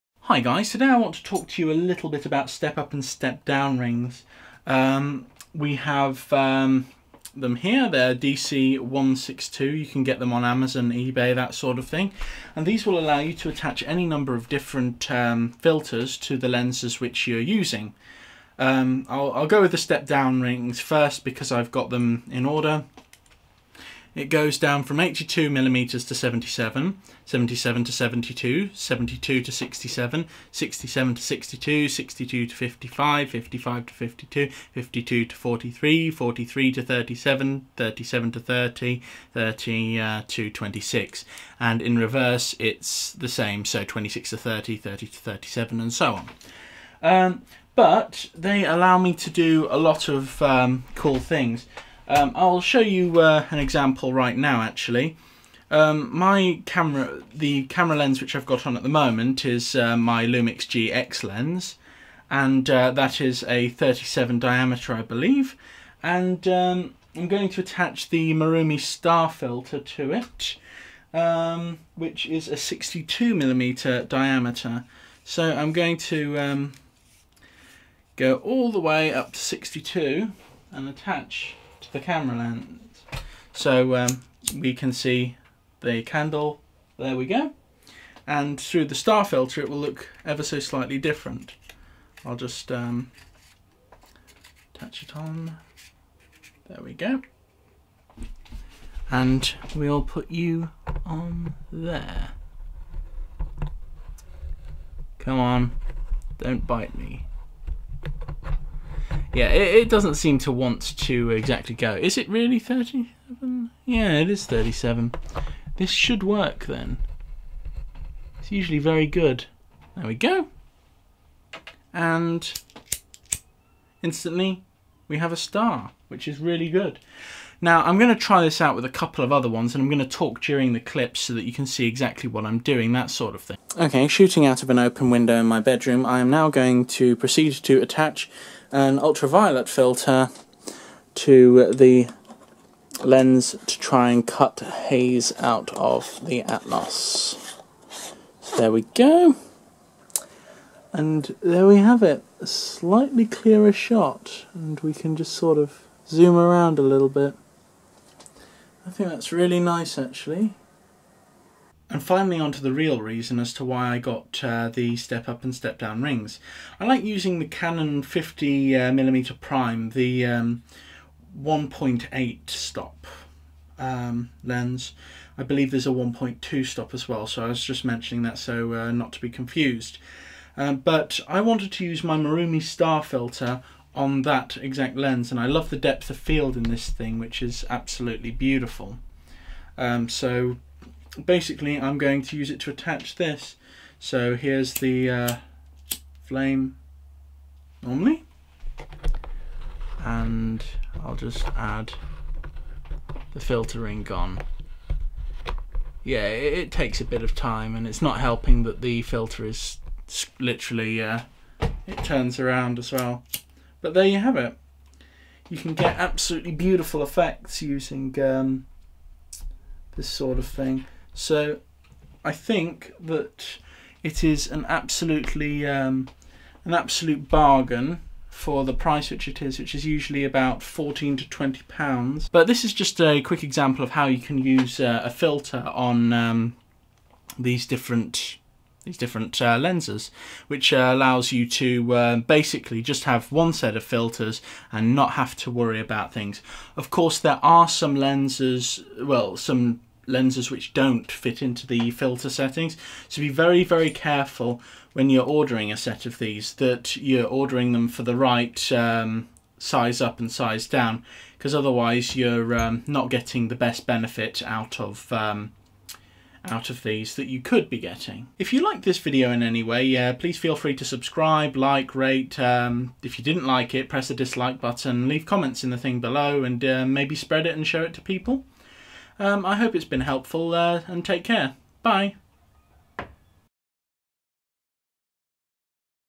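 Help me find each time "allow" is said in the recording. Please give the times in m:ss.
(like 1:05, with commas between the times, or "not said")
0:12, 4:00.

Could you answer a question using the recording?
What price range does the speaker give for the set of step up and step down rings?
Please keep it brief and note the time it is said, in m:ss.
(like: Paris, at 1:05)
14 to 20 pounds, at 3:50.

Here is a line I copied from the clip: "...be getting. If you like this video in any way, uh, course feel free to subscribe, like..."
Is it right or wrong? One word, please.
wrong.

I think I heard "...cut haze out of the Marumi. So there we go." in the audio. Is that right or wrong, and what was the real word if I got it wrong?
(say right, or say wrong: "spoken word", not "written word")
wrong: "Atmos", not "Marumi".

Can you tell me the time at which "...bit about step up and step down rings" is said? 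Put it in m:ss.
0:02.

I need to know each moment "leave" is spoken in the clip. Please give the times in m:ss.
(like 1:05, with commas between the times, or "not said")
4:35.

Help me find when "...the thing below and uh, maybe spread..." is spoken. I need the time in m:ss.
4:35.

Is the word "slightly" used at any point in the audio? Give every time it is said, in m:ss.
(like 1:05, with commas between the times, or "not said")
1:30, 2:32.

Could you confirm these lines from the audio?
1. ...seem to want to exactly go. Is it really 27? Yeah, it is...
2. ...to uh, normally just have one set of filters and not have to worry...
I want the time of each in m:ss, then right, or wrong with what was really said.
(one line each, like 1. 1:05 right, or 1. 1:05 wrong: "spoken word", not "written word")
1. 1:50 wrong: "37", not "27"
2. 4:01 wrong: "basically", not "normally".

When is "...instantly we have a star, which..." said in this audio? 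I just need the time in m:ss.
2:04.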